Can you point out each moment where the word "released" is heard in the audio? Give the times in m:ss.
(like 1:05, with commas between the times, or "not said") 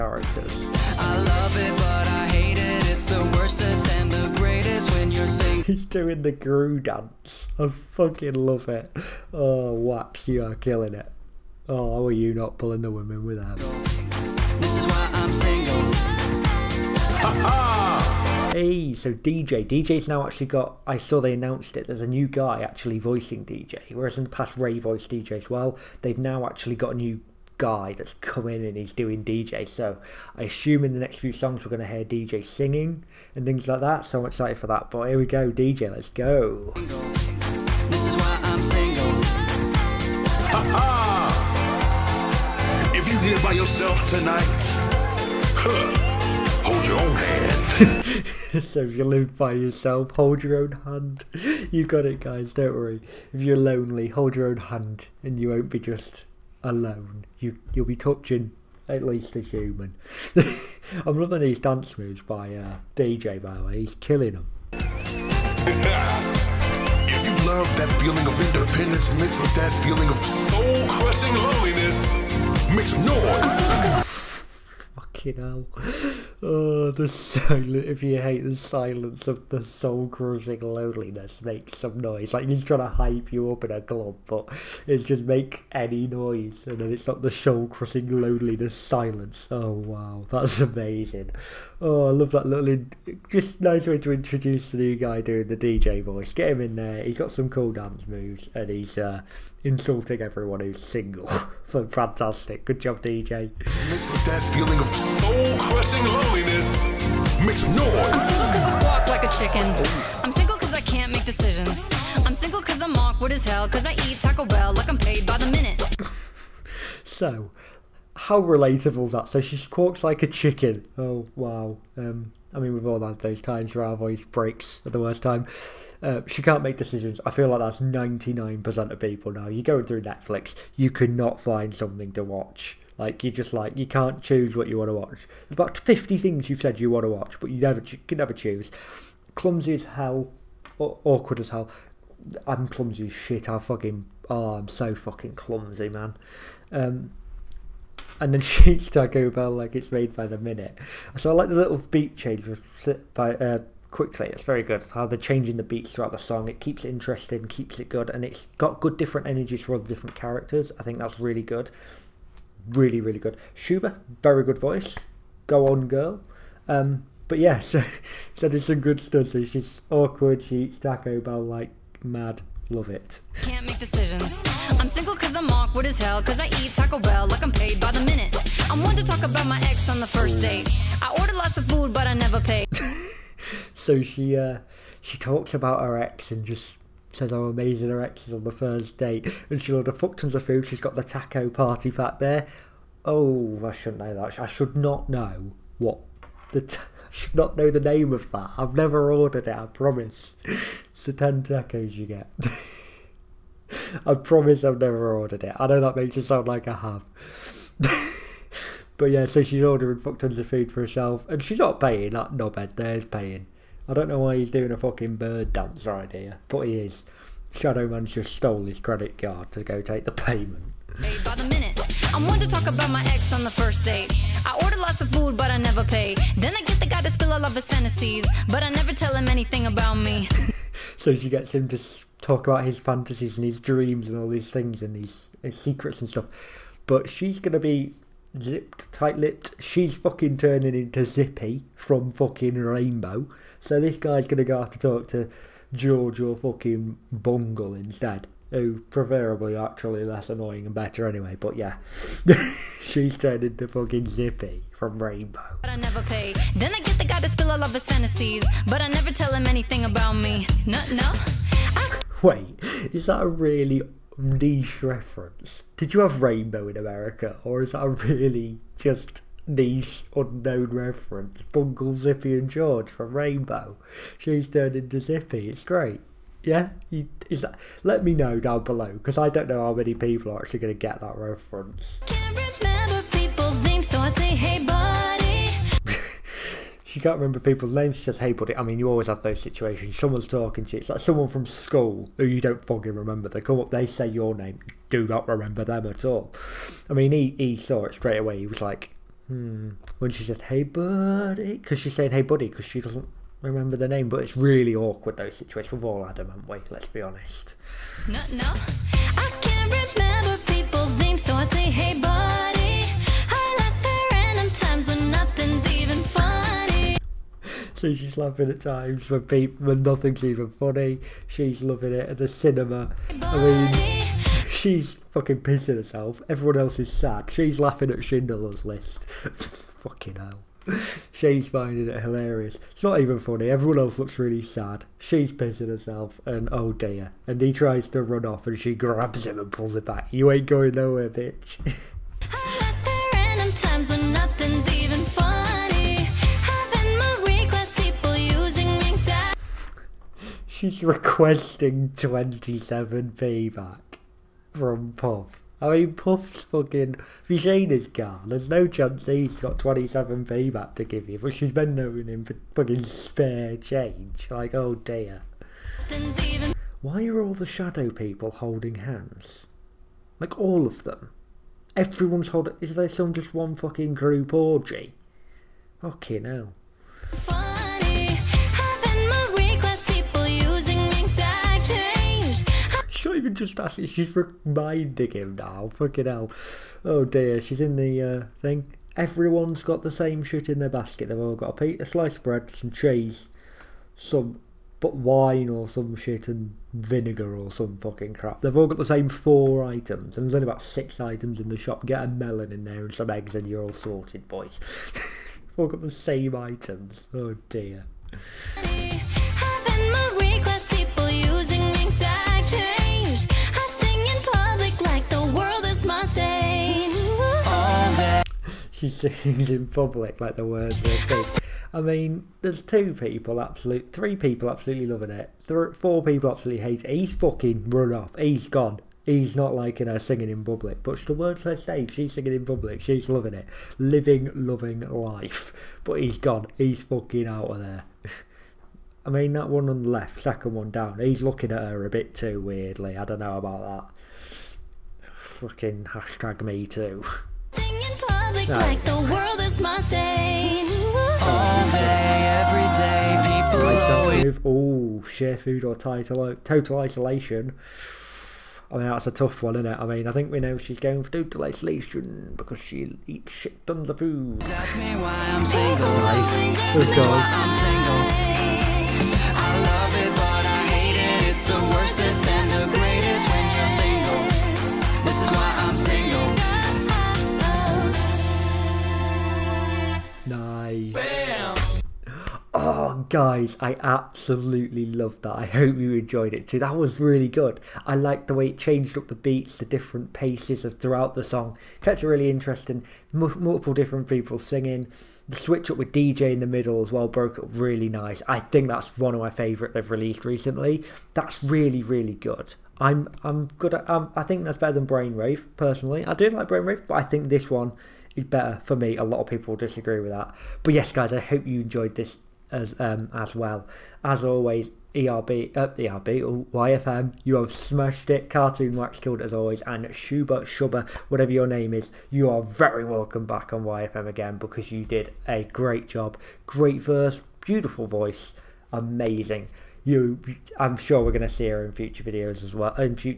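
8:19.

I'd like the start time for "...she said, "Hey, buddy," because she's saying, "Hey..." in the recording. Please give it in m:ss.
5:00.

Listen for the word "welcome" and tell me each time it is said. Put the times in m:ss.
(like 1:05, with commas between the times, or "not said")
8:42.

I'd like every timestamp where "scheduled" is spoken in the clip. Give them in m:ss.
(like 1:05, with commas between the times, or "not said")
not said.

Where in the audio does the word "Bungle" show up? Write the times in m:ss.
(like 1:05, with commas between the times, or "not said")
4:07, 4:31.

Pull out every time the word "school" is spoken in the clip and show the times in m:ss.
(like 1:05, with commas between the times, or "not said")
4:51.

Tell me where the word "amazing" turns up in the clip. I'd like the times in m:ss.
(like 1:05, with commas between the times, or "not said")
1:30, 3:07, 8:48.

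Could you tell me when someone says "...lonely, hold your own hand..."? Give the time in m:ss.
0:53.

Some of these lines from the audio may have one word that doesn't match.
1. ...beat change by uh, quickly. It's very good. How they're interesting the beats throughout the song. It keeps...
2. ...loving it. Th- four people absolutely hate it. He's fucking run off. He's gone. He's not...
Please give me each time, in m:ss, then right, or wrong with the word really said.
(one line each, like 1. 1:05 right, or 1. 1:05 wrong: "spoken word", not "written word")
1. 2:31 wrong: "changing", not "interesting"
2. 7:04 right.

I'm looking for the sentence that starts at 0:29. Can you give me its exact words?
So I assume in the next few songs we're going to hear DJ singing and things like that.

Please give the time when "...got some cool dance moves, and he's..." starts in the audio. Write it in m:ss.
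1:37.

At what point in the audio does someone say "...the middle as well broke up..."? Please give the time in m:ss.
8:16.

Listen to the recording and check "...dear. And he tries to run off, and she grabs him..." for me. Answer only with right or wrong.
right.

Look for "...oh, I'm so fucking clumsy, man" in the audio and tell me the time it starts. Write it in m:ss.
2:24.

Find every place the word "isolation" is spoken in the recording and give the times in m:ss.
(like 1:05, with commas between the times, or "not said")
7:36, 7:41.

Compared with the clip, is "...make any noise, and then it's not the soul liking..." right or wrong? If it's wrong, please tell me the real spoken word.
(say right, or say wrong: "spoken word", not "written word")
wrong: "crushing", not "liking".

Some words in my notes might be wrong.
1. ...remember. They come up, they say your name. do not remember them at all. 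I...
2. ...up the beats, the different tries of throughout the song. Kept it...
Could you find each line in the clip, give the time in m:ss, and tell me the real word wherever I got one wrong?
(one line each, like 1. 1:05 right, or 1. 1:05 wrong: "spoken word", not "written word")
1. 4:52 right
2. 8:08 wrong: "paces", not "tries".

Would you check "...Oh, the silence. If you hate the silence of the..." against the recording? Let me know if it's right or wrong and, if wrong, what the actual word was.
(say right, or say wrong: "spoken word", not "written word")
right.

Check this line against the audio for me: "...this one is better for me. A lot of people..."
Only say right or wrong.
right.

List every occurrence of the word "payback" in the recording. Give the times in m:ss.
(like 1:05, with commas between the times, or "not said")
5:53, 6:00.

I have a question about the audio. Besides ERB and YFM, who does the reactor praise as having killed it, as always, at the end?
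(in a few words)
Cartoon Wax.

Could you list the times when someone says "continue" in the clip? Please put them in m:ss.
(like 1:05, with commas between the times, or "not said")
not said.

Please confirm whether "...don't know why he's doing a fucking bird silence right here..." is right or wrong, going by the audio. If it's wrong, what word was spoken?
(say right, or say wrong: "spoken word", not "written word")
wrong: "dance", not "silence".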